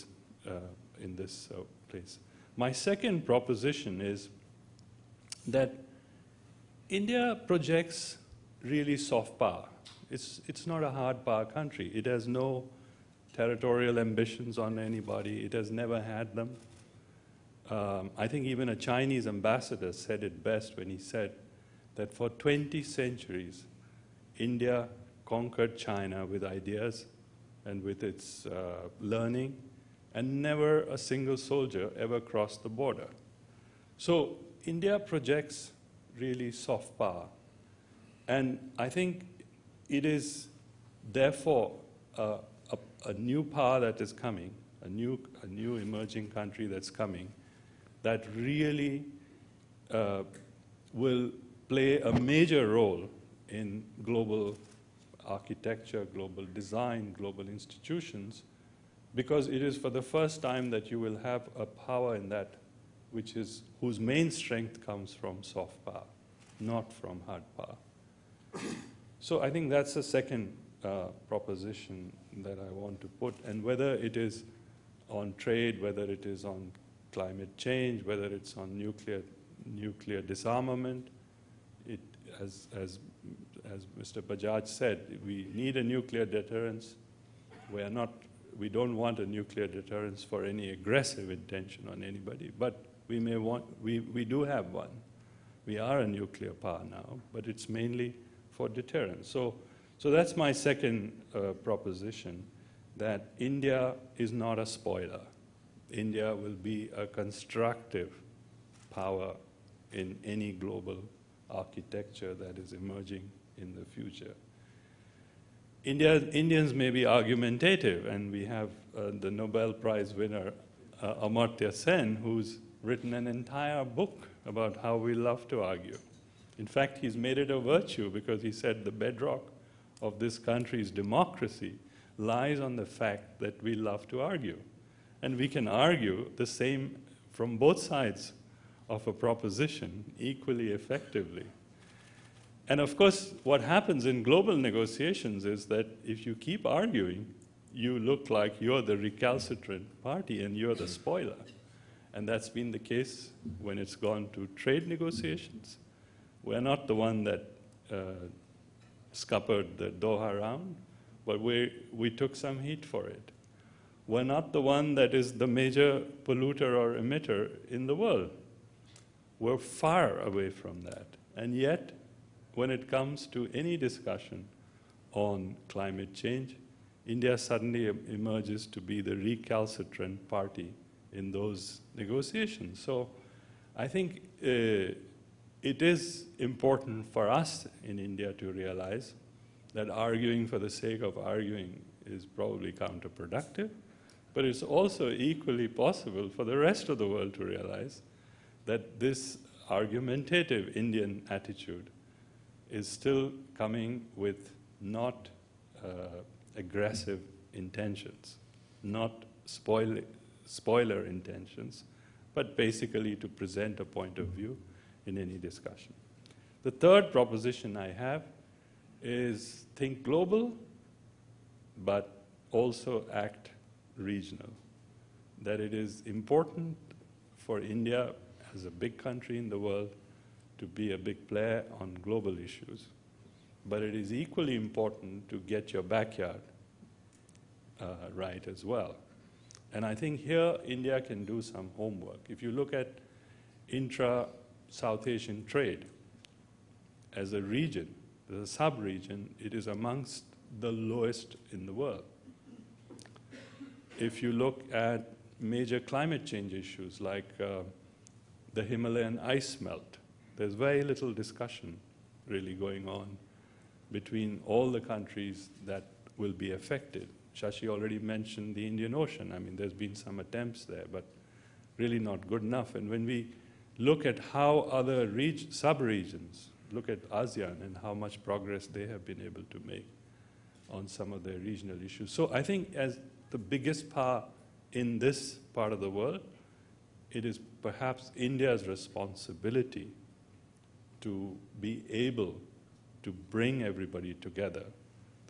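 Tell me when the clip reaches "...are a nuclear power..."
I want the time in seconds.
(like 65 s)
95 s.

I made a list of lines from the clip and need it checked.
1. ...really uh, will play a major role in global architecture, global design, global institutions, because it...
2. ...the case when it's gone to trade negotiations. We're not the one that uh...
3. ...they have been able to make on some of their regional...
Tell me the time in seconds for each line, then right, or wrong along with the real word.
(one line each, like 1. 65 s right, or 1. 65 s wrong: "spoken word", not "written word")
1. 48 s right
2. 152 s right
3. 278 s right.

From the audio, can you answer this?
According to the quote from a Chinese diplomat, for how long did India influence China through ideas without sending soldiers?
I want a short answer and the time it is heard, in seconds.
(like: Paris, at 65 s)
20 centuries, at 22 s.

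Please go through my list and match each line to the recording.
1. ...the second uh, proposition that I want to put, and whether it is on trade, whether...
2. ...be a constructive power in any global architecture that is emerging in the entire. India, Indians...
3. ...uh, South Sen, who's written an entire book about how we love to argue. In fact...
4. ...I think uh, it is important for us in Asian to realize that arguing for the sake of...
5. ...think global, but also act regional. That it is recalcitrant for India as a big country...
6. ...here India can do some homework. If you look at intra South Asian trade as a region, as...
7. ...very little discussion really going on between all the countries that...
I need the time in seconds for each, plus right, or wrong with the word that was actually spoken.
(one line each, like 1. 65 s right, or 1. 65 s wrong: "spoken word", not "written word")
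1. 69 s right
2. 106 s wrong: "future", not "entire"
3. 121 s wrong: "Amartya", not "South"
4. 183 s wrong: "India", not "Asian"
5. 219 s wrong: "important", not "recalcitrant"
6. 240 s right
7. 260 s right.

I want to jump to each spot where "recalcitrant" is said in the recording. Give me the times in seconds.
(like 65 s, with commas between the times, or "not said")
148 s, 179 s.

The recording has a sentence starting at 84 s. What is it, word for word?
Bajaj said, we need a nuclear deterrence.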